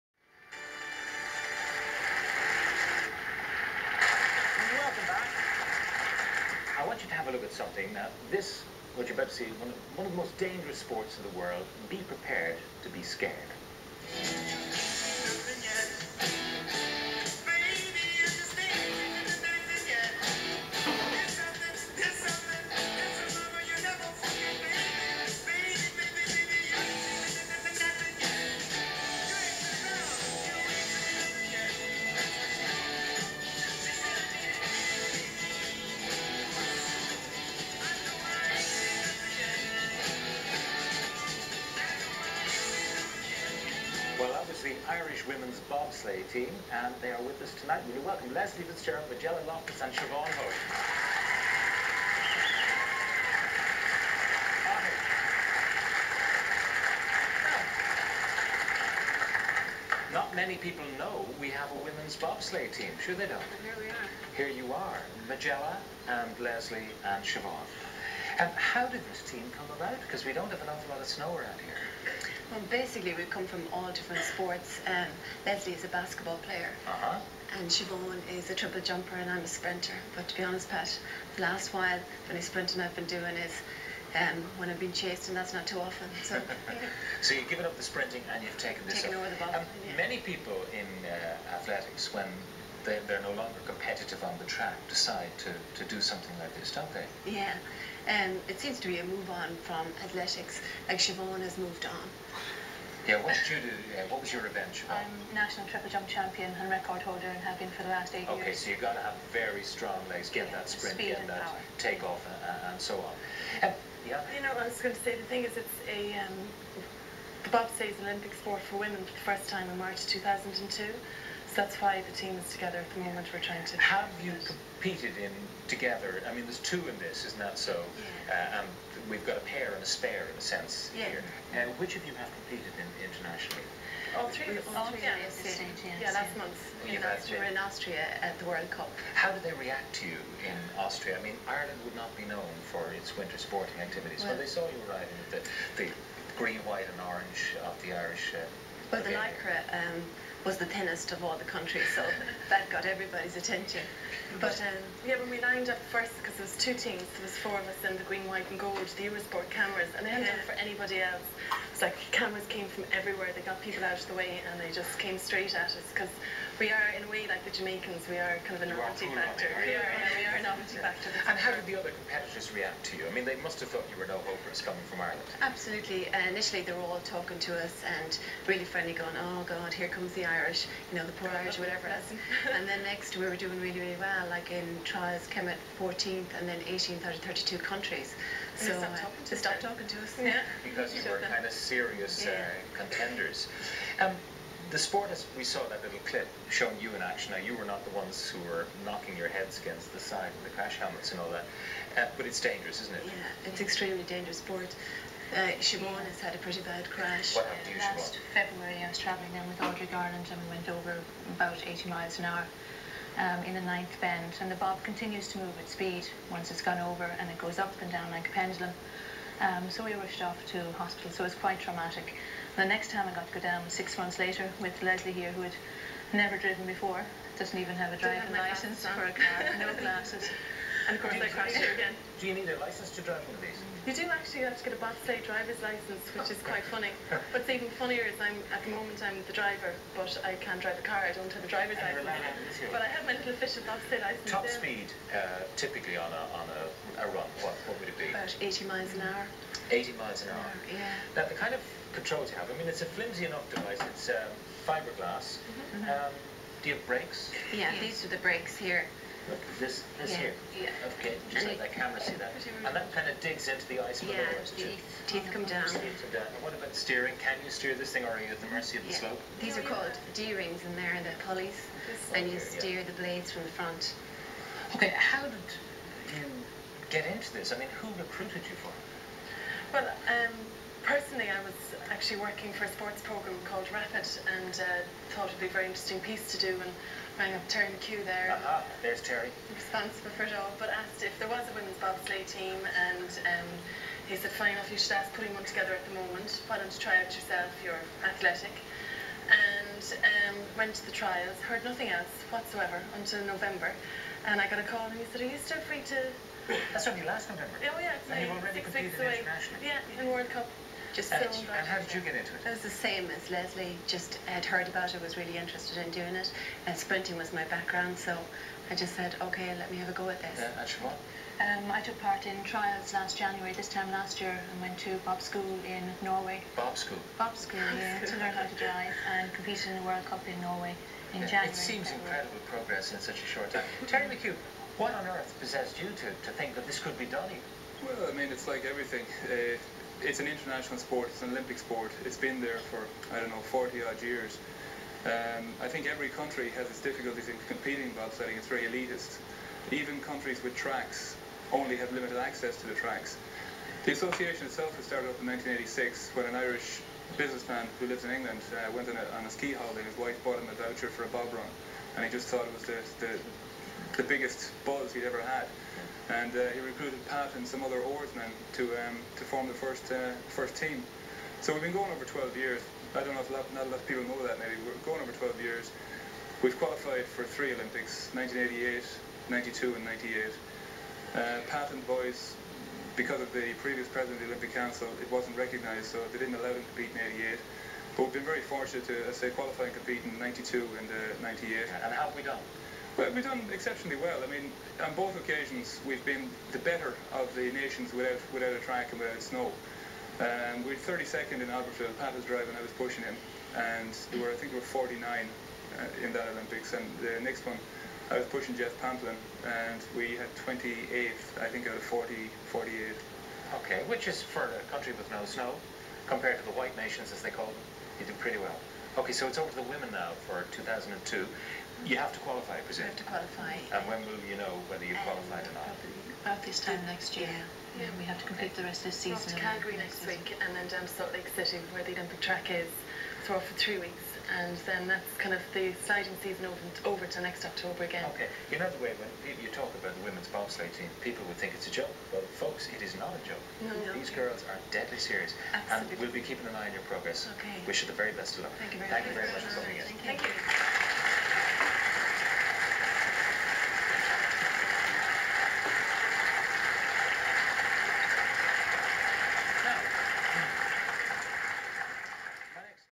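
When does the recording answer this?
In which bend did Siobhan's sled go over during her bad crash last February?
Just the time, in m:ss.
3:33.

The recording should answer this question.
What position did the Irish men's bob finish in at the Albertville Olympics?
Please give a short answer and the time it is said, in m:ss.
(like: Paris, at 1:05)
32nd, at 6:40.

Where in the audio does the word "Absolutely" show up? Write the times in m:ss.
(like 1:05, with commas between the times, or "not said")
2:55, 7:25.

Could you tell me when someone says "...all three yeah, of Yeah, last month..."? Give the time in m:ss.
2:14.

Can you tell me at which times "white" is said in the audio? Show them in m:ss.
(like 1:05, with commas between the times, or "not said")
2:26, 2:38, 6:56.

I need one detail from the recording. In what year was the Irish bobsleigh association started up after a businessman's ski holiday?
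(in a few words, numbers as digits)
1986.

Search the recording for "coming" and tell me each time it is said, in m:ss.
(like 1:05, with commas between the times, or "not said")
2:54.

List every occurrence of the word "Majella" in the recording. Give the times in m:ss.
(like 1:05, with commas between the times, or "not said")
0:49, 1:05.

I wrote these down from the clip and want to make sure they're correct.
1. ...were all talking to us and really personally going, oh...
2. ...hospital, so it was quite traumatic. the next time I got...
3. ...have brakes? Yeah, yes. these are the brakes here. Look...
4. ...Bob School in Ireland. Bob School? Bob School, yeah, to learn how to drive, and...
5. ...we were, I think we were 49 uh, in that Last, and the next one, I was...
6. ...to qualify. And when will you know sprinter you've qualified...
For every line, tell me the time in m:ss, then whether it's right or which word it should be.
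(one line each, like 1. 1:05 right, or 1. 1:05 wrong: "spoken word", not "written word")
1. 2:56 wrong: "friendly", not "personally"
2. 3:40 right
3. 4:16 right
4. 5:25 wrong: "Norway", not "Ireland"
5. 6:44 wrong: "Olympics", not "Last"
6. 7:02 wrong: "whether", not "sprinter".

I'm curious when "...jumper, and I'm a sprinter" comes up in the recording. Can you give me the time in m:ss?
1:18.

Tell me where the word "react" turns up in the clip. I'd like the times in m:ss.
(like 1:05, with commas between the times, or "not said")
2:19, 2:52.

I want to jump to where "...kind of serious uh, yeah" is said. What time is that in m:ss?
3:11.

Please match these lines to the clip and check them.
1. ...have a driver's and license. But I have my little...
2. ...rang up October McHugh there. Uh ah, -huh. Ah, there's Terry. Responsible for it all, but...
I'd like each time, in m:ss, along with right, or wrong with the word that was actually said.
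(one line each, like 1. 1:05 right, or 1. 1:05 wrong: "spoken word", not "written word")
1. 4:01 right
2. 4:47 wrong: "Terry", not "October".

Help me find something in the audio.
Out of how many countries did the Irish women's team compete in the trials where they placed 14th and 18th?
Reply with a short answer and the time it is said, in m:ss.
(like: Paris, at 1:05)
32, at 3:07.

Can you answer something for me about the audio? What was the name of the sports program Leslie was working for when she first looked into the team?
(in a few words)
Rapid.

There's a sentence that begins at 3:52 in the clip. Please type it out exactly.
Do you need a license to drive one of these?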